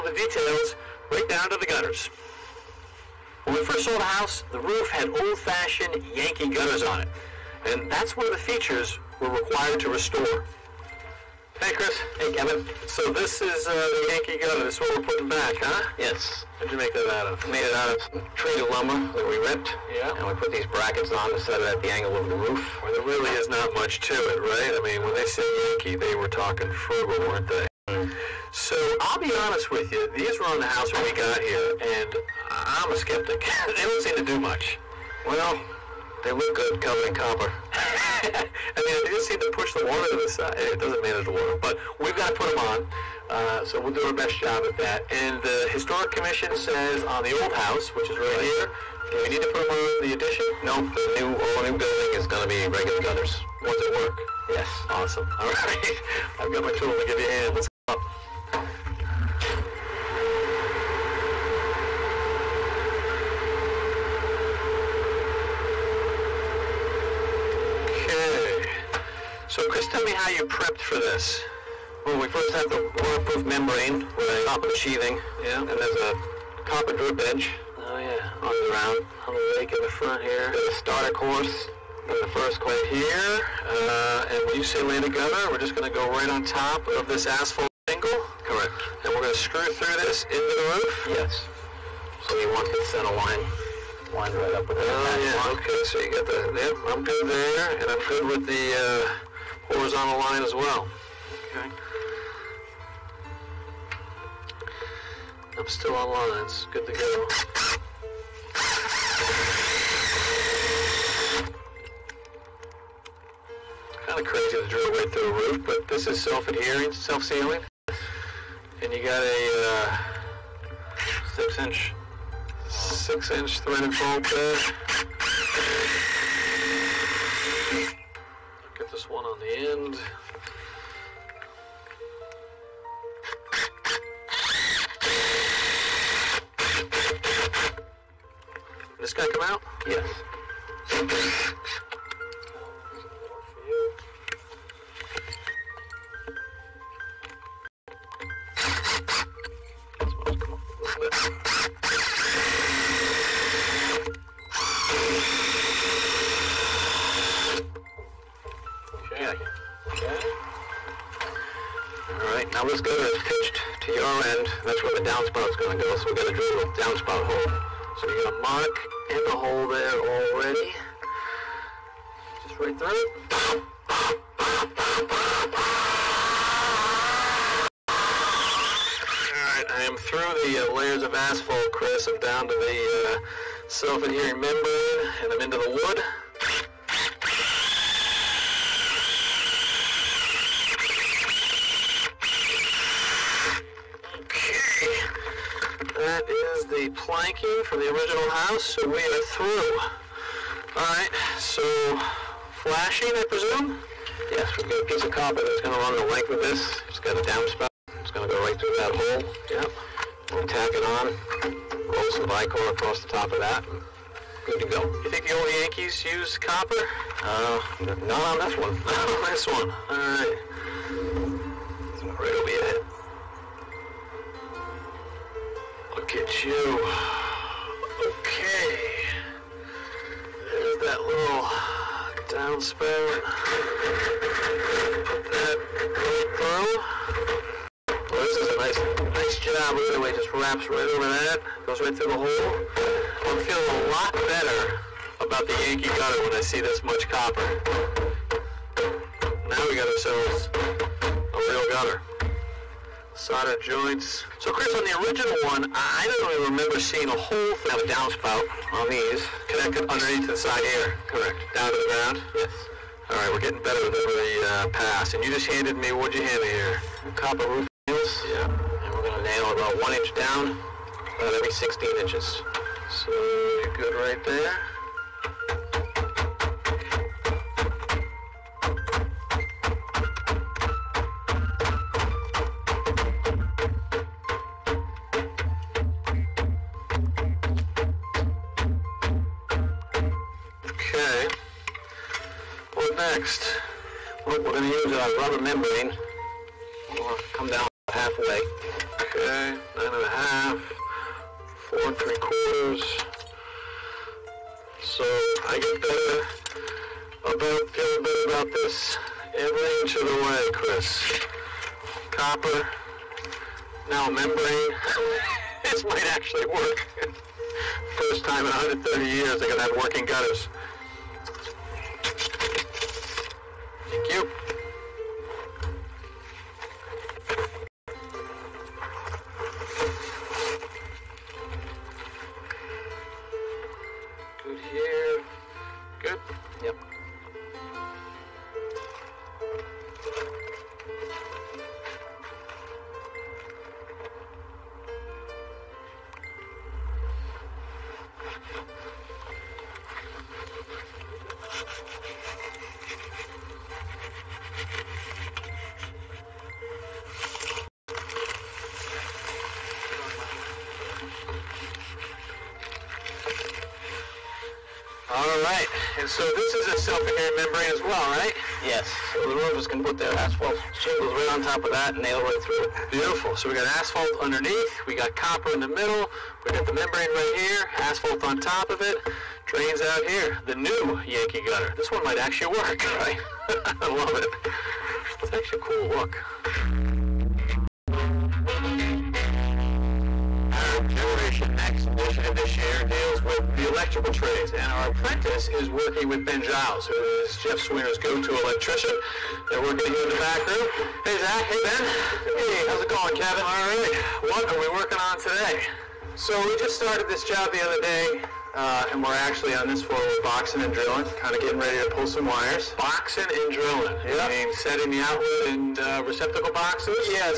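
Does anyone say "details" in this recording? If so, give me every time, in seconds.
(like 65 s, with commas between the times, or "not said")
0 s.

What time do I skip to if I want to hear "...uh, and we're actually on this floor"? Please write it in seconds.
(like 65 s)
408 s.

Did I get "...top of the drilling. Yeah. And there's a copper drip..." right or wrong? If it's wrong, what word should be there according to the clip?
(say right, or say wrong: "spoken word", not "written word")
wrong: "sheathing", not "drilling".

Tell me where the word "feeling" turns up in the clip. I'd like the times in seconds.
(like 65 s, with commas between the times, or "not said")
243 s, 307 s.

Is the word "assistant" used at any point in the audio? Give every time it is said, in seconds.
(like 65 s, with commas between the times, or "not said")
not said.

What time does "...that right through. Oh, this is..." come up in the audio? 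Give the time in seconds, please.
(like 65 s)
235 s.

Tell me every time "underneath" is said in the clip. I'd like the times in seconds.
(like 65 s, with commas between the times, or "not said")
259 s, 374 s.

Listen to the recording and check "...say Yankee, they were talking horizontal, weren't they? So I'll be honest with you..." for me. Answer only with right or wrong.
wrong.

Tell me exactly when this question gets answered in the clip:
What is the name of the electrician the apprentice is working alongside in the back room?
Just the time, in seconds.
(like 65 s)
396 s.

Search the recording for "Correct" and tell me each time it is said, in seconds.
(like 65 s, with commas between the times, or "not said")
88 s, 261 s.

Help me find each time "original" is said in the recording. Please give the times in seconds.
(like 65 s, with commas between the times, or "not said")
197 s, 254 s.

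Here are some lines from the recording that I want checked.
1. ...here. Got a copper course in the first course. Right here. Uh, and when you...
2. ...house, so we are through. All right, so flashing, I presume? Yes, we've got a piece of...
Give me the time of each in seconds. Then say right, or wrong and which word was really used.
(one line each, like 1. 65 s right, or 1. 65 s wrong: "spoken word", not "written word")
1. 80 s wrong: "starter", not "copper"
2. 198 s right.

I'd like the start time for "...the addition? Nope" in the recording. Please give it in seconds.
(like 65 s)
50 s.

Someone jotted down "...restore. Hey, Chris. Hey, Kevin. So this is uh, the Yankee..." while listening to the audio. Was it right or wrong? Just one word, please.
right.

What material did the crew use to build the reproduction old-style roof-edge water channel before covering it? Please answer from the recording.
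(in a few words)
treated lumber.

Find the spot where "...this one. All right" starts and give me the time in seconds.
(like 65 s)
219 s.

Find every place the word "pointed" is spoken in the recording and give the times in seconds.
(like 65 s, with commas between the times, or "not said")
not said.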